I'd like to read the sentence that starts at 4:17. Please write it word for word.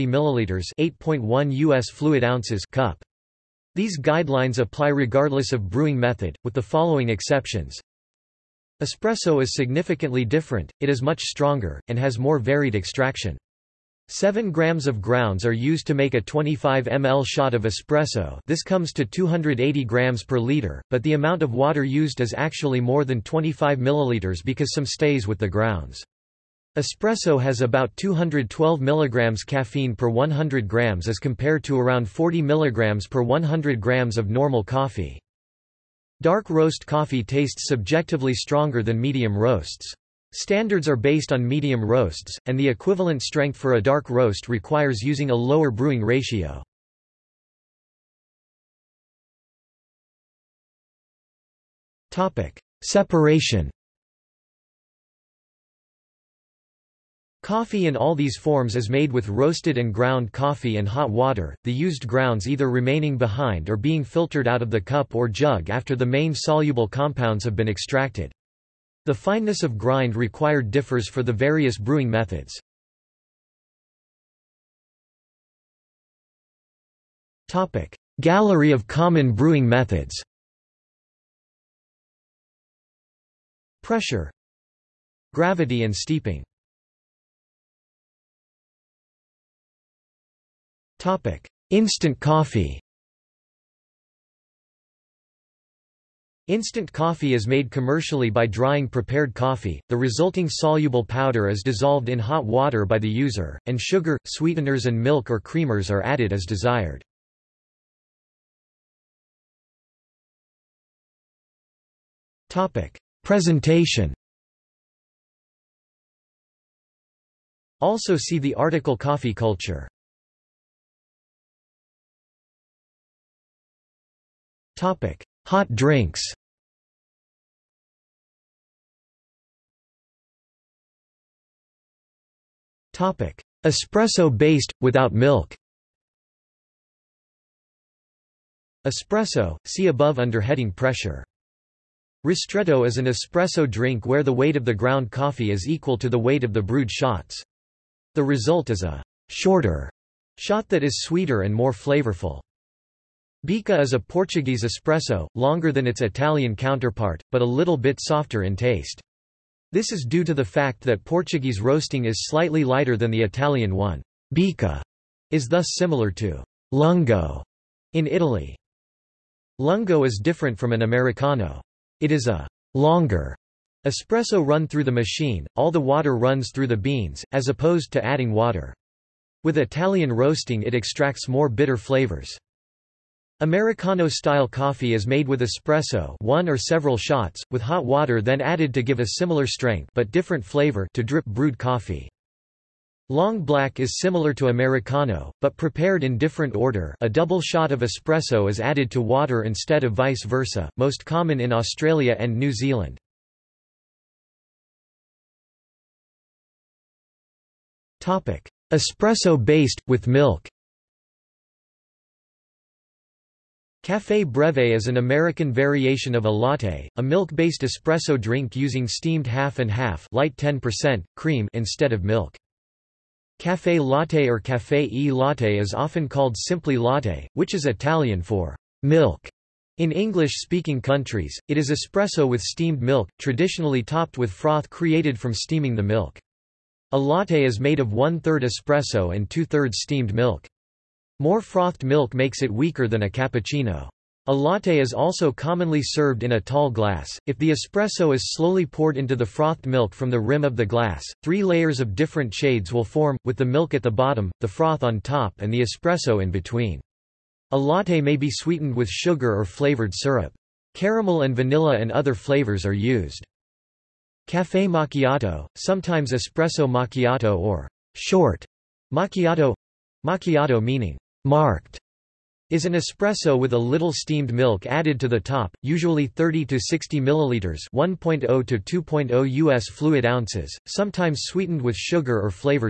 A latte may be sweetened with sugar or flavored syrup.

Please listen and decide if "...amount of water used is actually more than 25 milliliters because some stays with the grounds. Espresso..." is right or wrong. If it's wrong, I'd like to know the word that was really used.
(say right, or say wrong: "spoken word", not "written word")
right.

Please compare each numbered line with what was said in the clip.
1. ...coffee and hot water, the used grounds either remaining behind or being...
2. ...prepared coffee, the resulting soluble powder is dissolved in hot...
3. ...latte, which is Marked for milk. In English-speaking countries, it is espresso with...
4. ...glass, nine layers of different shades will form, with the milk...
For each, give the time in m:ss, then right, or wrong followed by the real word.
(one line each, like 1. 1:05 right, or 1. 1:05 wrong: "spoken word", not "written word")
1. 1:00 right
2. 1:38 right
3. 3:46 wrong: "Italian", not "Marked"
4. 4:10 wrong: "three", not "nine".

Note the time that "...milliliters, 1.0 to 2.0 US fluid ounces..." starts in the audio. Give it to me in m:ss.
4:36.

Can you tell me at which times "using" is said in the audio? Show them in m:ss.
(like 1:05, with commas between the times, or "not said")
0:45, 3:38.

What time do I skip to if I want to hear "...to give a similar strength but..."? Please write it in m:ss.
3:08.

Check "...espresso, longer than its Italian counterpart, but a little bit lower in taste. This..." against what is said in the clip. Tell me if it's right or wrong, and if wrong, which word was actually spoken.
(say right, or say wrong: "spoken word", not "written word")
wrong: "softer", not "lower".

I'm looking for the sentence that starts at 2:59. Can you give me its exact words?
With Italian roasting it extracts more bitter flavors.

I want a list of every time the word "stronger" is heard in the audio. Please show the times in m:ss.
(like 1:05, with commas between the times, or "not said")
0:11, 0:38.